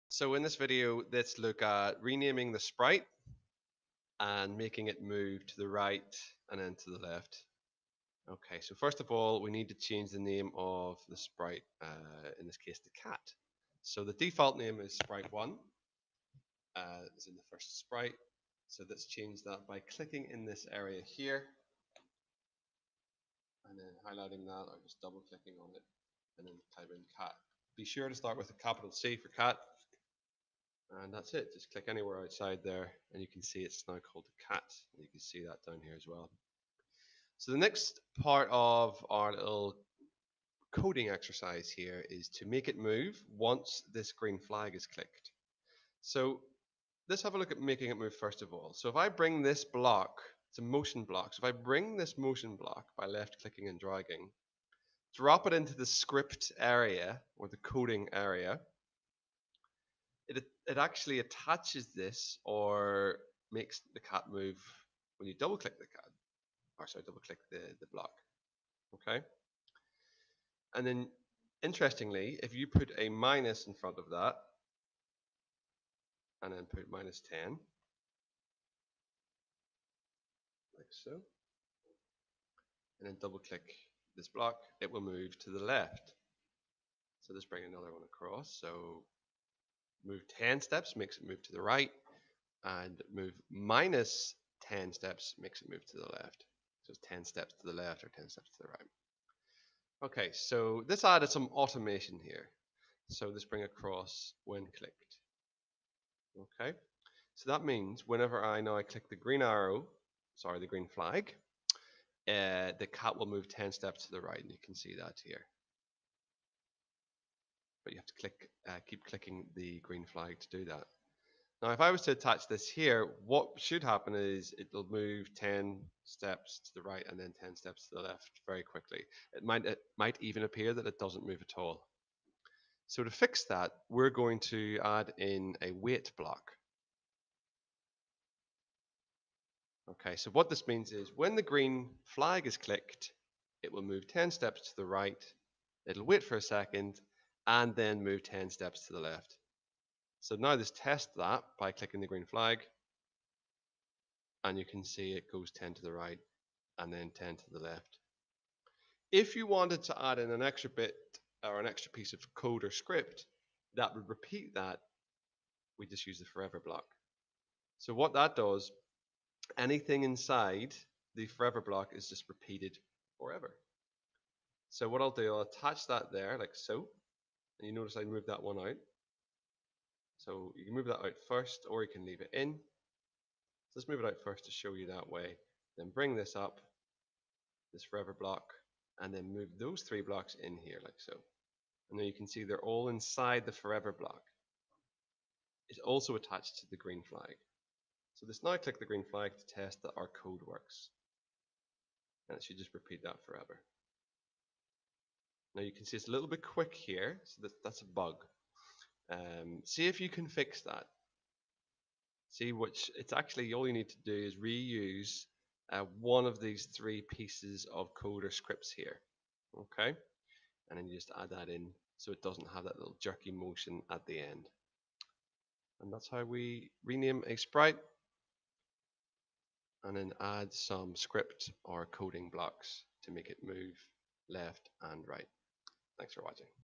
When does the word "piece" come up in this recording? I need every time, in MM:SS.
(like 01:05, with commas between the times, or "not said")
02:41, 03:37.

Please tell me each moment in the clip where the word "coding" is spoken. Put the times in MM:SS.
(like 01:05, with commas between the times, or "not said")
00:40, 00:57, 03:51.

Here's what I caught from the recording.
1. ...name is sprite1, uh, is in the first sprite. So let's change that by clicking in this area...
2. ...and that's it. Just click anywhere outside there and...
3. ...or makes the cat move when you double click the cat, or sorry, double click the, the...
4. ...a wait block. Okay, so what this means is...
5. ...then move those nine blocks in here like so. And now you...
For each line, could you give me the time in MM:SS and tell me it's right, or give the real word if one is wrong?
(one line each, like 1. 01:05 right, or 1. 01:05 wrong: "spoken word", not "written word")
1. 00:14 right
2. 00:31 right
3. 01:02 right
4. 02:15 right
5. 03:09 wrong: "three", not "nine".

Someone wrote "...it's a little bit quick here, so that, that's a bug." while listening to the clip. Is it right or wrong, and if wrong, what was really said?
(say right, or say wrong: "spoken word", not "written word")
right.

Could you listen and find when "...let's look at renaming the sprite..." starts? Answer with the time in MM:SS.
00:01.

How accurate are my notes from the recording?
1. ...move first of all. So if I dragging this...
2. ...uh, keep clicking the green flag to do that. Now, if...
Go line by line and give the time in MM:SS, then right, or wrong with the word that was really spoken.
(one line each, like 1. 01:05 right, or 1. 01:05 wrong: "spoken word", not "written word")
1. 00:47 wrong: "bring", not "dragging"
2. 01:58 right.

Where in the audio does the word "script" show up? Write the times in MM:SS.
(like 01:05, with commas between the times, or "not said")
00:55, 02:42, 03:38, 03:50.